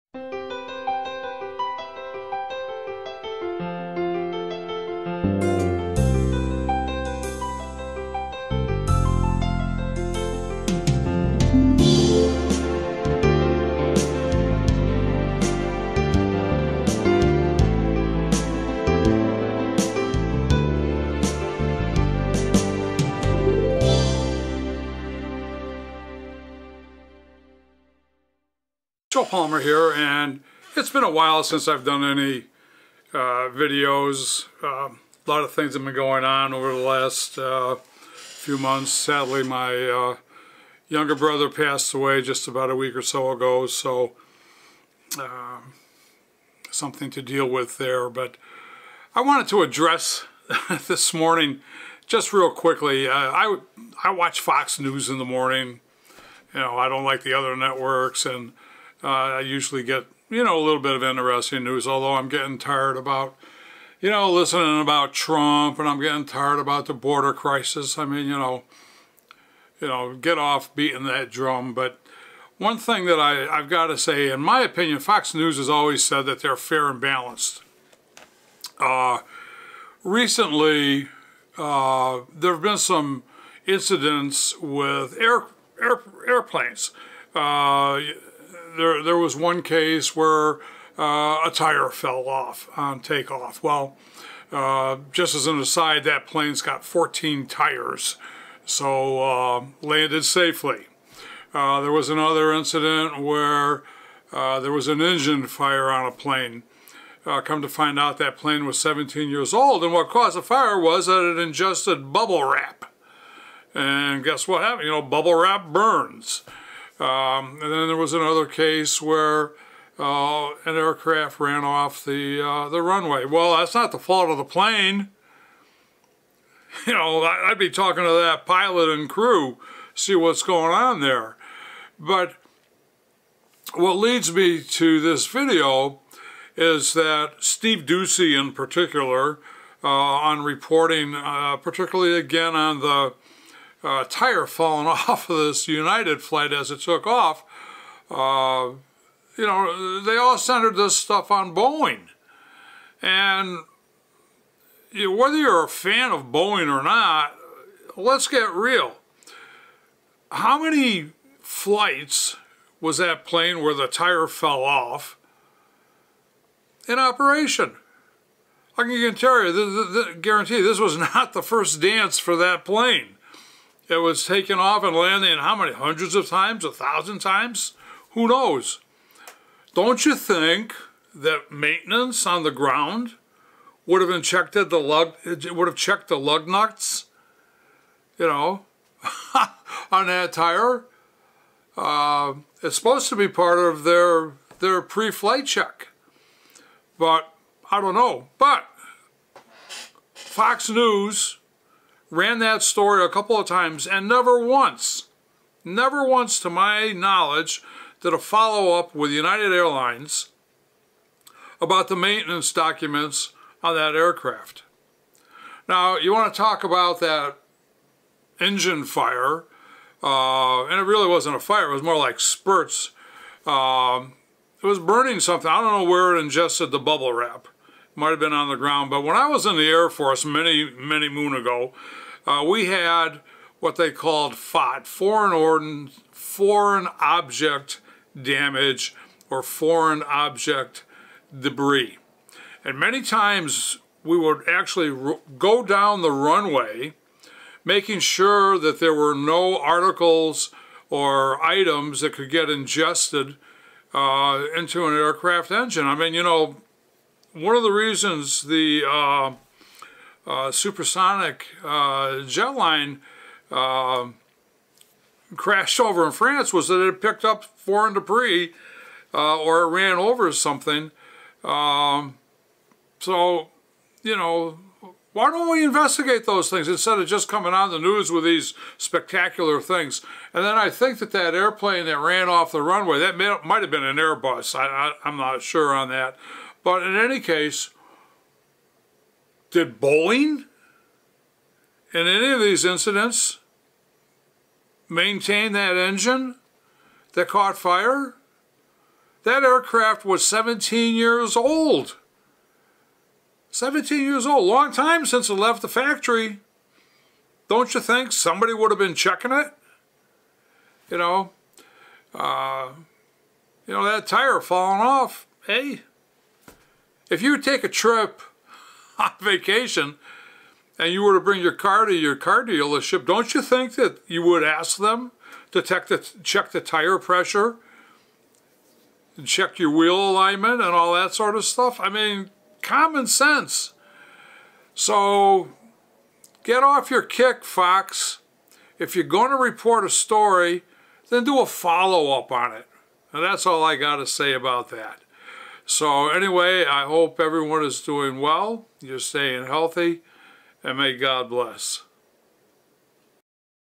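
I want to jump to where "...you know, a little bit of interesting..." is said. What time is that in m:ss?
1:00.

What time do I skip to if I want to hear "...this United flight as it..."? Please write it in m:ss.
2:25.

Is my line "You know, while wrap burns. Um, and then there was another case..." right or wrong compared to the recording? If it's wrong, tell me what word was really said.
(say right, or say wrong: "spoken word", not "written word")
wrong: "bubble", not "while".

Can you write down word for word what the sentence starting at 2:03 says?
Well, that's not the fault of the plane.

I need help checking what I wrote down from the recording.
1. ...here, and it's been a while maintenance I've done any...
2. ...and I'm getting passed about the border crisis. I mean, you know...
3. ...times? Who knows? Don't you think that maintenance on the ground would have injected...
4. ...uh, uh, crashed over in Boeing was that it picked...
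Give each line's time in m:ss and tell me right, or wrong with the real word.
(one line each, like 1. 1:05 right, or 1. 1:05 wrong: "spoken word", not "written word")
1. 0:29 wrong: "since", not "maintenance"
2. 1:05 wrong: "tired", not "passed"
3. 2:57 right
4. 4:21 wrong: "France", not "Boeing".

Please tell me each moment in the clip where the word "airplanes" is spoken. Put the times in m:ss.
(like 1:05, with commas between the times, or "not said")
1:26, 4:41.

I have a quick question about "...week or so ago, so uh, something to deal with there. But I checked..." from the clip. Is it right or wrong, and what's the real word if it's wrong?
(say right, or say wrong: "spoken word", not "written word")
wrong: "wanted", not "checked".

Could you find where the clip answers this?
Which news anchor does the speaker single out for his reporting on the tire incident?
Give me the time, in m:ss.
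2:17.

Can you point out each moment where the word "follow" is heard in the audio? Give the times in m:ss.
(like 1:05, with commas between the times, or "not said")
3:28, 5:41.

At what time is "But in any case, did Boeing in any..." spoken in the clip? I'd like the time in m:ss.
4:46.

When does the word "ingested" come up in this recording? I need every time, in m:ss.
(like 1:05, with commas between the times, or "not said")
1:51, 3:46, 4:12.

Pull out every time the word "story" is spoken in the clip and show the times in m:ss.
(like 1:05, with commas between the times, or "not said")
3:22, 5:39.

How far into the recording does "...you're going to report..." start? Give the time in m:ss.
5:38.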